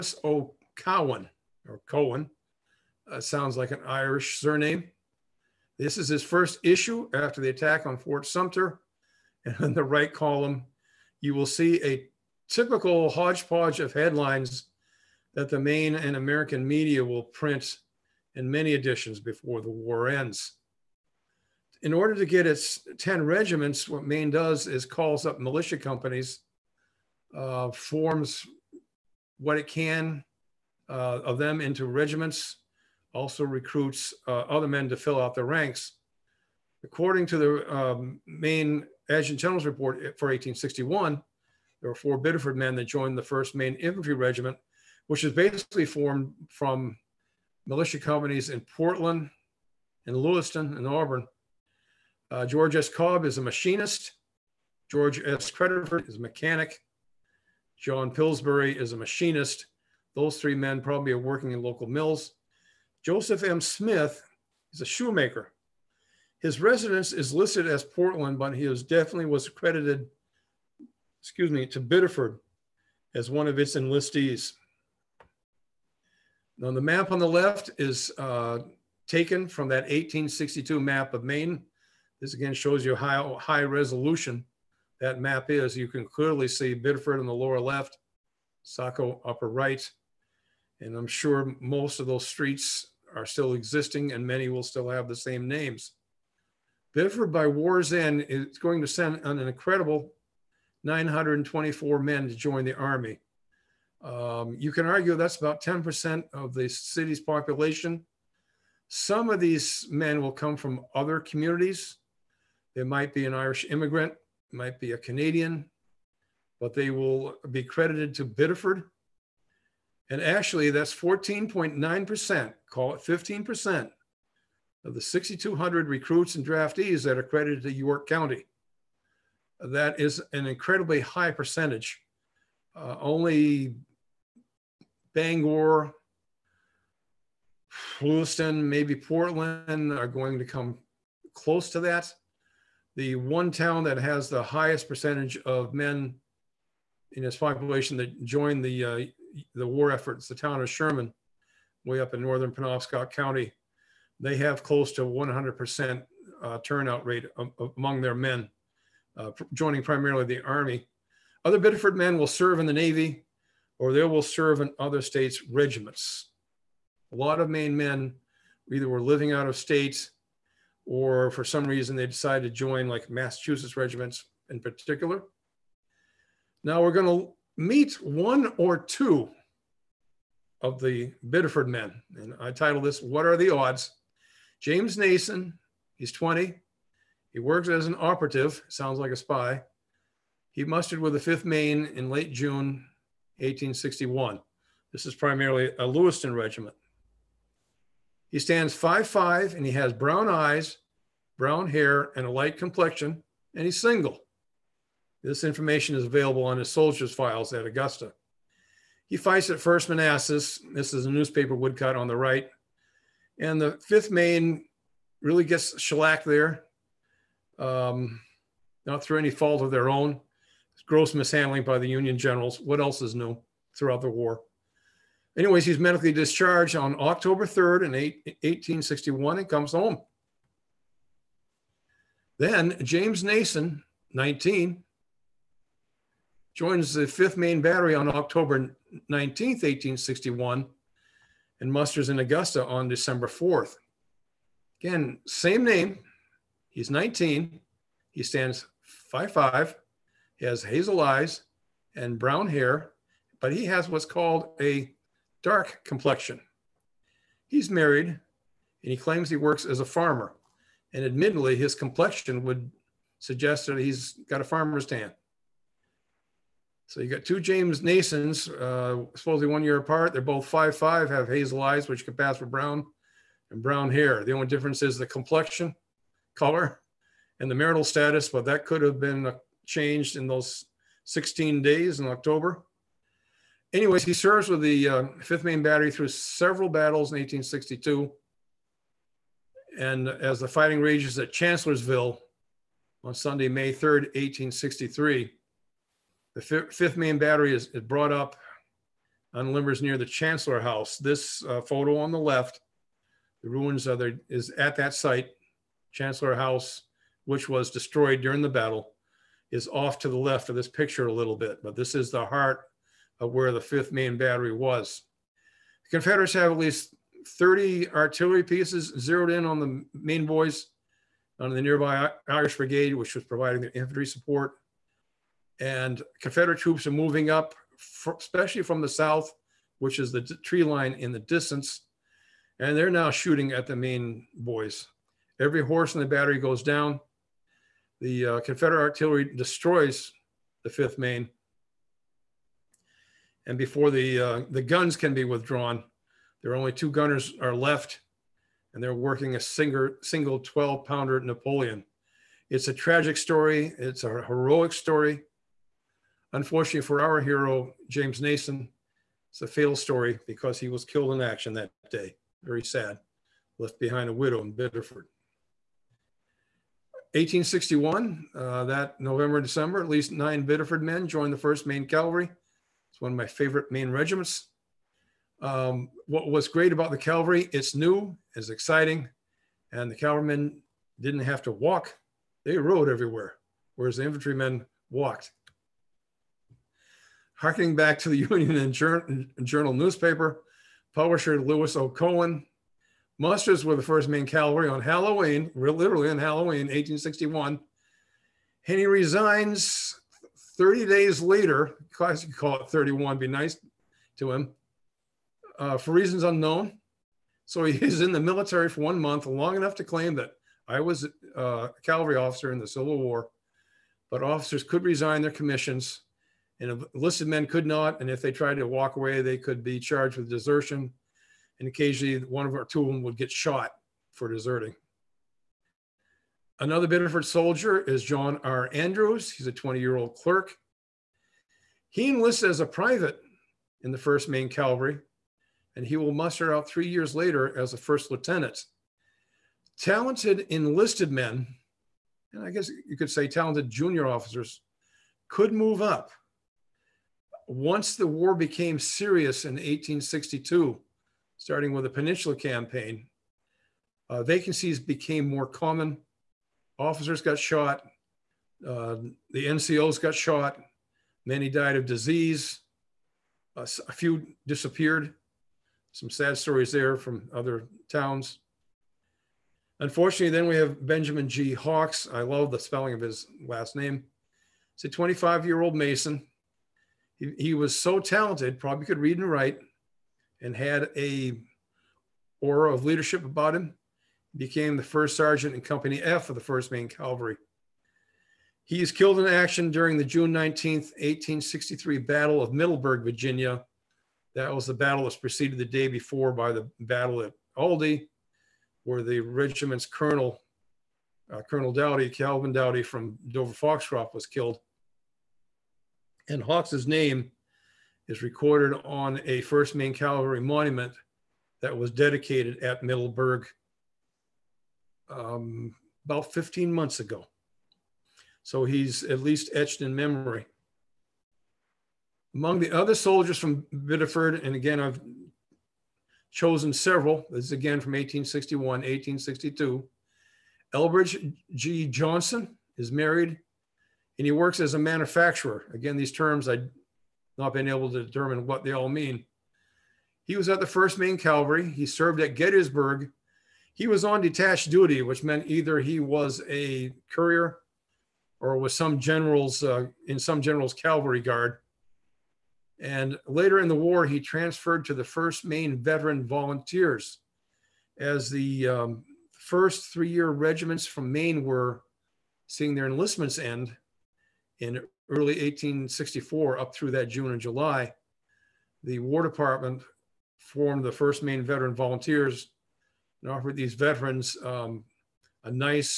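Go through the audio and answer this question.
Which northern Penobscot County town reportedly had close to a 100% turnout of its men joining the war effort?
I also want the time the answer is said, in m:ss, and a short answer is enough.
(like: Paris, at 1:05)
Sherman, at 2:30.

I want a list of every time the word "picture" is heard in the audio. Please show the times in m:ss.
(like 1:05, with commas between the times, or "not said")
5:10.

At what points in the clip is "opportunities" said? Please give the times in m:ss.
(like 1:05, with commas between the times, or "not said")
not said.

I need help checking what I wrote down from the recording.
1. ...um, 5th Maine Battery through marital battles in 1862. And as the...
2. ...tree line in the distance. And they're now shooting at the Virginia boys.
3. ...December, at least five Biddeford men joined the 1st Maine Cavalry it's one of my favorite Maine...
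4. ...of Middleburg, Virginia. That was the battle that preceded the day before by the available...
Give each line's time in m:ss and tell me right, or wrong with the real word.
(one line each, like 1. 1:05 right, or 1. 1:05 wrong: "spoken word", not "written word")
1. 4:44 wrong: "several", not "marital"
2. 5:30 wrong: "Maine", not "Virginia"
3. 6:09 wrong: "nine", not "five"
4. 8:12 wrong: "battle", not "available".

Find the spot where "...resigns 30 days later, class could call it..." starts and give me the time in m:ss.
6:38.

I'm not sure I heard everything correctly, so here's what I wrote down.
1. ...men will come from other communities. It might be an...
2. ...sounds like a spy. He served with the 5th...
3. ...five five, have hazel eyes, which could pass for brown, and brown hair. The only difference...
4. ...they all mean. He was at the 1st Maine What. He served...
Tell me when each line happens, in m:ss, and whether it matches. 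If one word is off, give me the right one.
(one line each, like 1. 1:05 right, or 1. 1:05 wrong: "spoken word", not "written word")
1. 1:49 right
2. 3:08 wrong: "mustered", not "served"
3. 4:30 right
4. 8:58 wrong: "Cavalry", not "What".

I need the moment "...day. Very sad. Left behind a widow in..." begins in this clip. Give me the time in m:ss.
6:01.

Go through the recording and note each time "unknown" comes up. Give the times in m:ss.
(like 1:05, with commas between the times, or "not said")
6:46.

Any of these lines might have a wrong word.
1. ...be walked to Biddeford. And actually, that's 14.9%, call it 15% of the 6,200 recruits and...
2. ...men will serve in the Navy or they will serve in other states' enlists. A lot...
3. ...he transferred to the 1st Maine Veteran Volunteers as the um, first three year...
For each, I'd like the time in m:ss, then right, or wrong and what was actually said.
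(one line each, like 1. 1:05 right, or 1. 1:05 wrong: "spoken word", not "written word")
1. 1:57 wrong: "credited", not "walked"
2. 2:41 wrong: "regiments", not "enlists"
3. 9:14 right.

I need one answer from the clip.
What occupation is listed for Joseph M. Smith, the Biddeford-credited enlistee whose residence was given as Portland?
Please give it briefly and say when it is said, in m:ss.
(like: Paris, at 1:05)
Shoemaker, at 1:04.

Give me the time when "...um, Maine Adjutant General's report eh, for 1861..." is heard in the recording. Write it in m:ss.
0:37.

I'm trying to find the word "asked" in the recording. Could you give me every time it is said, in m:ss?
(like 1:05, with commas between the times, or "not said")
not said.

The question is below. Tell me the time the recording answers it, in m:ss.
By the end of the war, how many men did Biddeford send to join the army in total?
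1:40.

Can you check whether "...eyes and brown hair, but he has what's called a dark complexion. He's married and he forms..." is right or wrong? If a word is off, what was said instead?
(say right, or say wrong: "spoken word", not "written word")
wrong: "claims", not "forms".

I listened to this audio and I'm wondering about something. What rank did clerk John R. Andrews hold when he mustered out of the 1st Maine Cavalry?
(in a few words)
First lieutenant.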